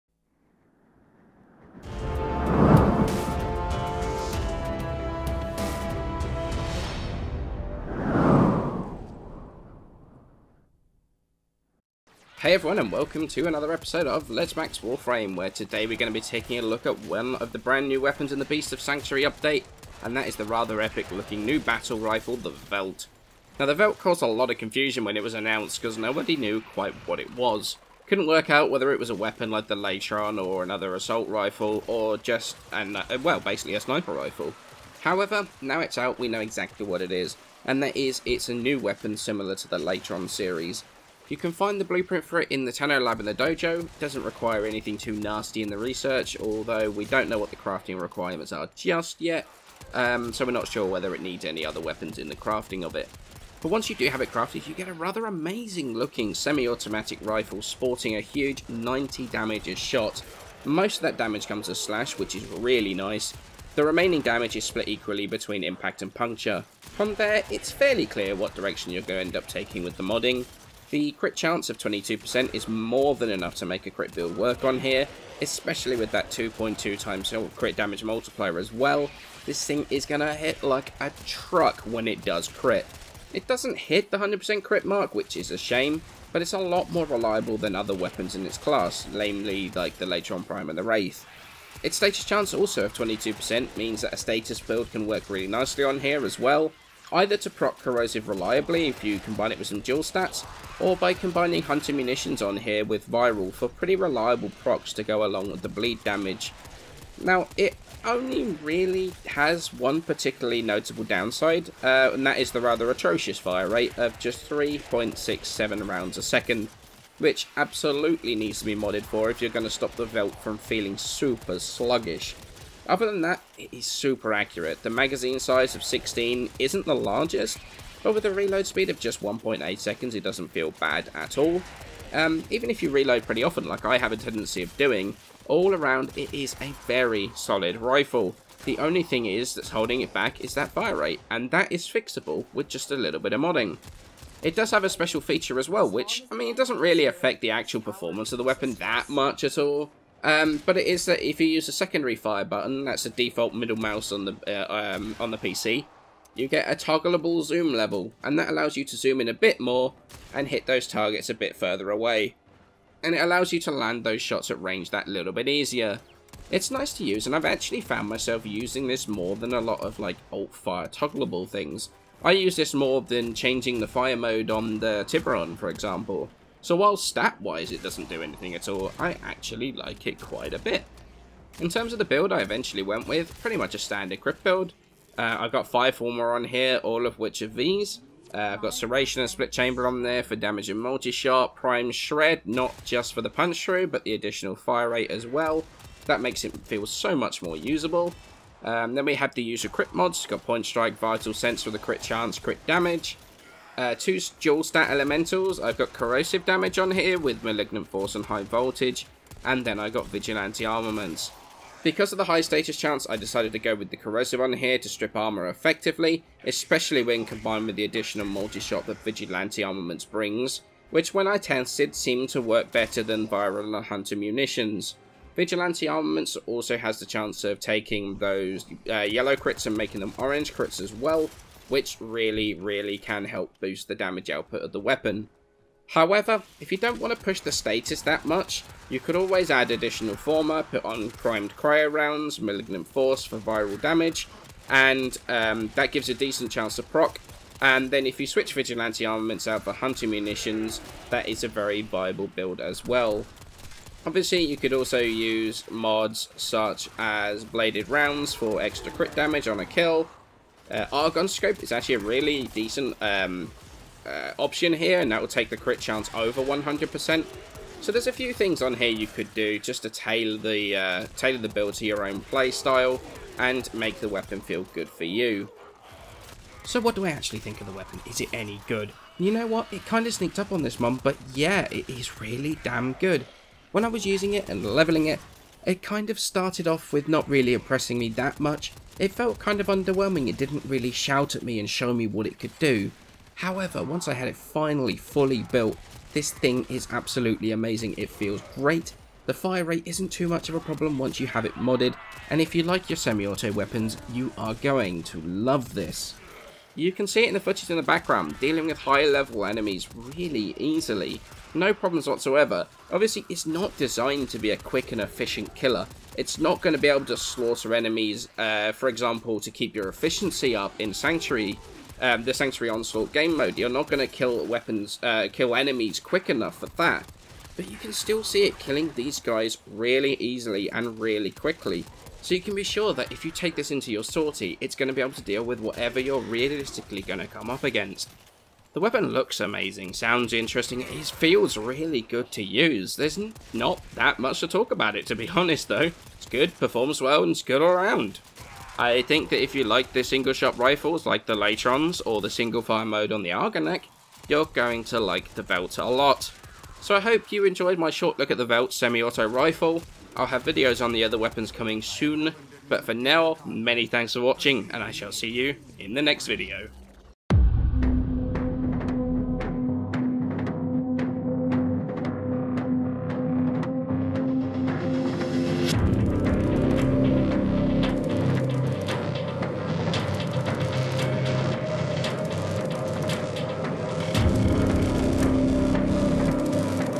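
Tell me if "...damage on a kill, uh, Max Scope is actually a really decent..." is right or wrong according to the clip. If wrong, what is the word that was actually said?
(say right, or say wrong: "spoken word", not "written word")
wrong: "Argon", not "Max".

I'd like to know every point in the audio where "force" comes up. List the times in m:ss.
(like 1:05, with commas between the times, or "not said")
3:27, 4:02.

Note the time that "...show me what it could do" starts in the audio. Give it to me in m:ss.
4:51.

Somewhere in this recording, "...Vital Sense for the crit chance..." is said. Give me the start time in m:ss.
3:20.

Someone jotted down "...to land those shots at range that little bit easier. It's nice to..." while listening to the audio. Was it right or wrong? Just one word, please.
right.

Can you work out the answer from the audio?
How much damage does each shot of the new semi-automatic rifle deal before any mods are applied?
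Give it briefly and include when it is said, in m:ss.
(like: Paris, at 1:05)
90, at 0:58.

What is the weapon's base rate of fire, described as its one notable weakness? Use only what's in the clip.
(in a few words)
3.67 rounds a second.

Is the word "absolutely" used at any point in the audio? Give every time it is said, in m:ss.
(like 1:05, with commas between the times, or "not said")
1:57, 4:56.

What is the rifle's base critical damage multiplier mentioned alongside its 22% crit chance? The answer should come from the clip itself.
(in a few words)
2.2 times.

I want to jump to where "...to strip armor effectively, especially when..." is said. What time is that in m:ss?
3:34.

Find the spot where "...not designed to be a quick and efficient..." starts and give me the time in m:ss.
5:13.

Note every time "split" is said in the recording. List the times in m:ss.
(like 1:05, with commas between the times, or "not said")
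1:04, 3:09.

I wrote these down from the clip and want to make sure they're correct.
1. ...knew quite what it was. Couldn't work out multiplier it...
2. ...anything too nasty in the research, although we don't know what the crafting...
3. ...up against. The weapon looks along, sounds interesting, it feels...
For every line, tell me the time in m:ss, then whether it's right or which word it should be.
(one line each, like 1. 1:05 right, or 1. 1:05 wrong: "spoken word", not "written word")
1. 0:26 wrong: "whether", not "multiplier"
2. 0:44 right
3. 5:37 wrong: "amazing", not "along".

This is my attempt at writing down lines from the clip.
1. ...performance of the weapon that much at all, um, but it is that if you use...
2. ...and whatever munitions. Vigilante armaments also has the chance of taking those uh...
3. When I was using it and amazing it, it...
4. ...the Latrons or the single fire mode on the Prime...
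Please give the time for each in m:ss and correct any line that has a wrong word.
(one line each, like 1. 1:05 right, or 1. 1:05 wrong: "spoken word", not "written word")
1. 2:27 right
2. 3:43 wrong: "hunter", not "whatever"
3. 4:43 wrong: "leveling", not "amazing"
4. 5:51 wrong: "Argonak", not "Prime".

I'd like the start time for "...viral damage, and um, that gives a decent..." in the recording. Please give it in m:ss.
4:03.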